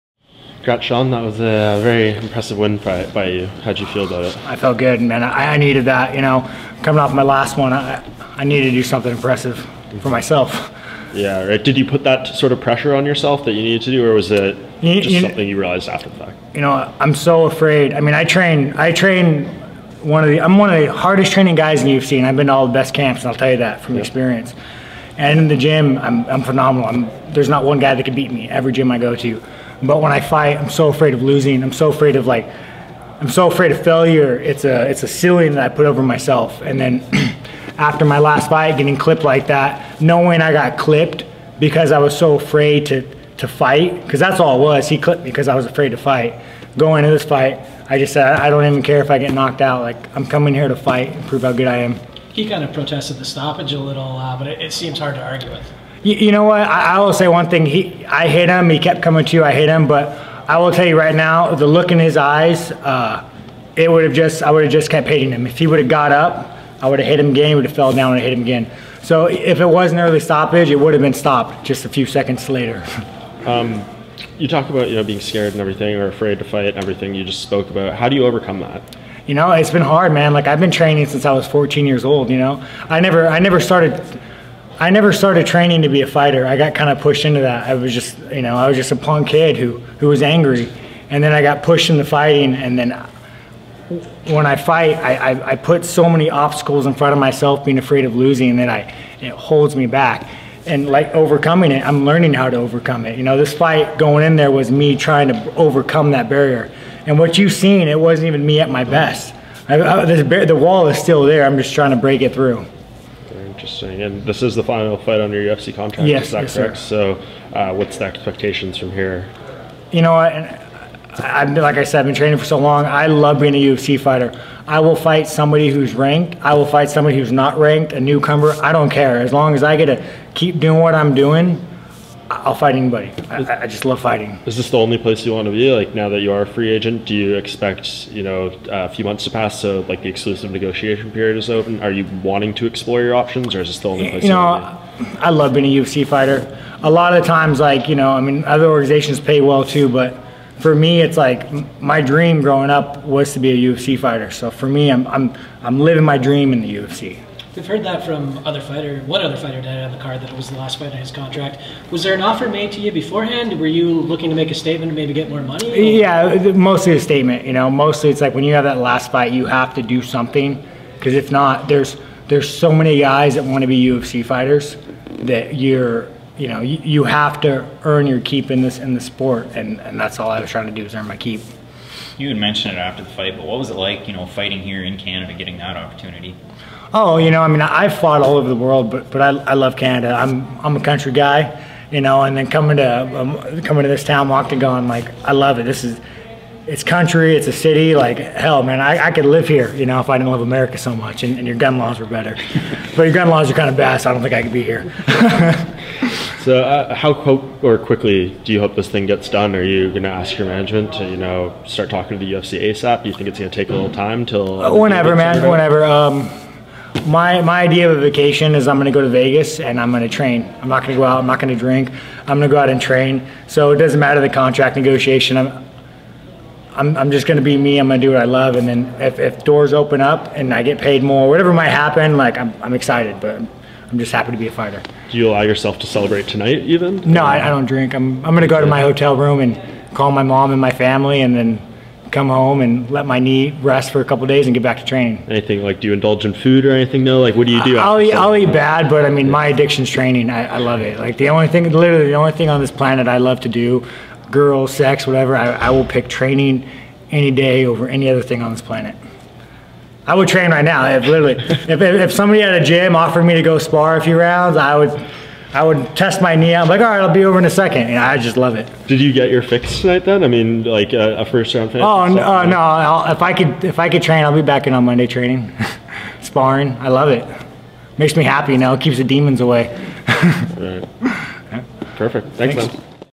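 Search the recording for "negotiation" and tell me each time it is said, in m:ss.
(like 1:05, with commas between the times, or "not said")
2:20, 3:44.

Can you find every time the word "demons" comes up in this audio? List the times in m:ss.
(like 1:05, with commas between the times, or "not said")
4:39.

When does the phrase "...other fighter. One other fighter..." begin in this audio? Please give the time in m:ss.
2:38.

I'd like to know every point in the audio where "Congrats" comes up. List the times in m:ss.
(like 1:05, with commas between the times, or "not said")
0:00.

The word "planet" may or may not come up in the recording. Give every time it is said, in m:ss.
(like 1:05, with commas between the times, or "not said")
4:12, 4:18.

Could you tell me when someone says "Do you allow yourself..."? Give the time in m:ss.
3:55.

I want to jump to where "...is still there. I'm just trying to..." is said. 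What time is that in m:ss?
1:50.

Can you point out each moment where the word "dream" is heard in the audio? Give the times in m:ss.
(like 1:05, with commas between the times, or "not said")
2:32, 2:36.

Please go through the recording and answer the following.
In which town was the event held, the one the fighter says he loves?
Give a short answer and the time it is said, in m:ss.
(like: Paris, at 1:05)
Moncton, at 3:14.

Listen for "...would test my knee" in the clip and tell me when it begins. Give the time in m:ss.
4:25.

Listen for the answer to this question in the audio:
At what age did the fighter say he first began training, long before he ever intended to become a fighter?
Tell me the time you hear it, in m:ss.
1:21.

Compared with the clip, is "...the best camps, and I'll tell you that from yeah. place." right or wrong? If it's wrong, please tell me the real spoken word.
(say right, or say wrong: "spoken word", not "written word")
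wrong: "experience", not "place".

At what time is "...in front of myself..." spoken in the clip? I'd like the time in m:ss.
1:36.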